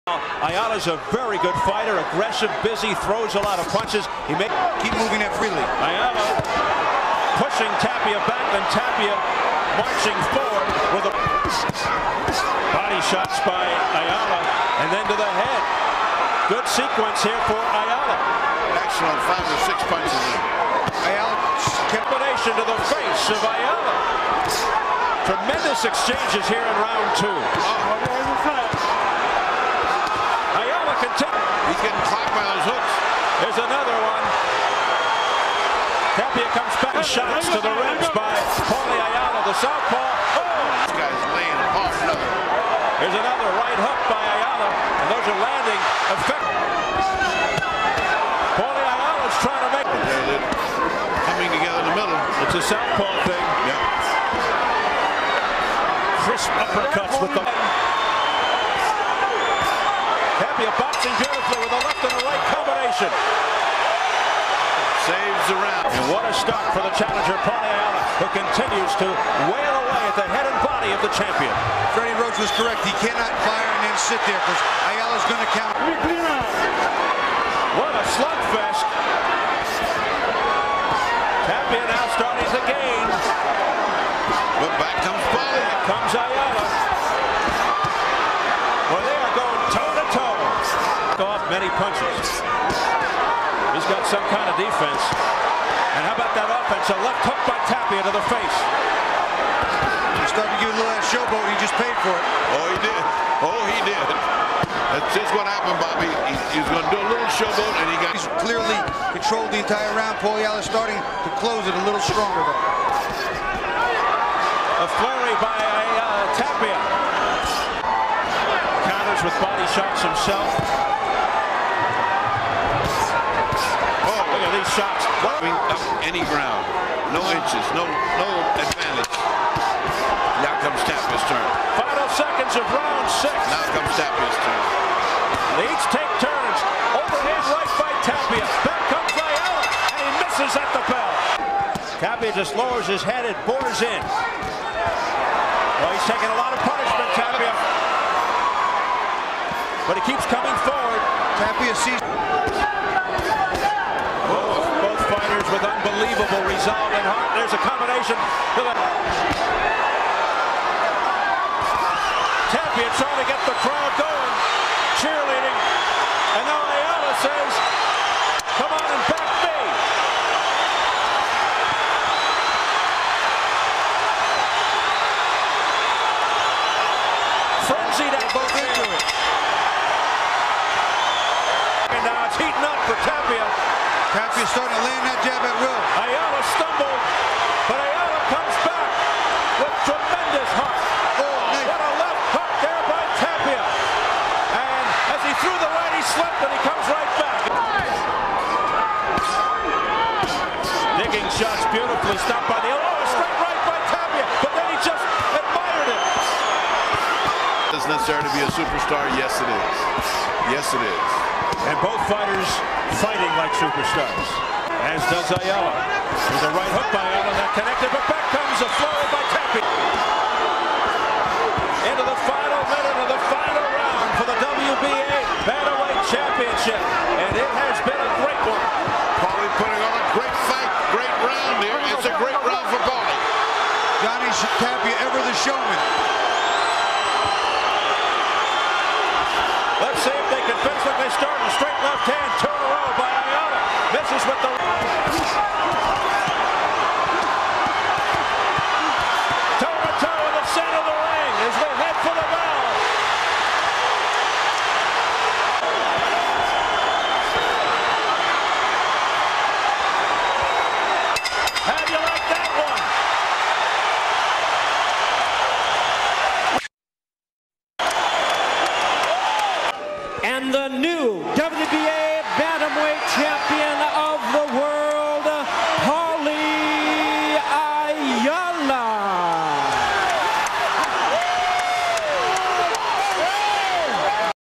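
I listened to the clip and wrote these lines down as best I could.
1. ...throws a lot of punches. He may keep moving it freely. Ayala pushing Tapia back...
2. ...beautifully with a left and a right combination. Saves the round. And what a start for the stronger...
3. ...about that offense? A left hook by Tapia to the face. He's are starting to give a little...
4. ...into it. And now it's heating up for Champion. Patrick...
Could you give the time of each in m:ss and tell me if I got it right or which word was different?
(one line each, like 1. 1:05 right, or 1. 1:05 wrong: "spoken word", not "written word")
1. 0:03 right
2. 1:01 wrong: "challenger", not "stronger"
3. 1:36 right
4. 2:58 wrong: "Tapia", not "Champion".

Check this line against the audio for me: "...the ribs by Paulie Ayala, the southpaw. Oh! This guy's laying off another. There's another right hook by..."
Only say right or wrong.
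right.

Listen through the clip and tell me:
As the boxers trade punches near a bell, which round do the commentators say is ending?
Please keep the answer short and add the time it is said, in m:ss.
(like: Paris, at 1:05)
Round 6, at 2:12.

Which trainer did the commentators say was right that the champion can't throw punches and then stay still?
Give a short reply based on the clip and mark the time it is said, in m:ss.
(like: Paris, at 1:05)
Freddie Roach, at 1:11.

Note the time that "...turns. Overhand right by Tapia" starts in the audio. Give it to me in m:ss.
2:16.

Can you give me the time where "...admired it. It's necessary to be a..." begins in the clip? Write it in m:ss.
3:25.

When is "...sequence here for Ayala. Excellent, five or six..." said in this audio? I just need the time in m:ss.
0:16.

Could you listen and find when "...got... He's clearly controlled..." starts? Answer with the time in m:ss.
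1:48.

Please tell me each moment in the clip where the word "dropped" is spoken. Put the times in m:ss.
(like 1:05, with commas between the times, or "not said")
not said.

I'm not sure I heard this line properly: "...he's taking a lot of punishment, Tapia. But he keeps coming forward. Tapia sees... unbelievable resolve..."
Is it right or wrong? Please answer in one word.
right.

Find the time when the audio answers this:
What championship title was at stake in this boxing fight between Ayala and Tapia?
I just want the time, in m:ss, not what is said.
3:44.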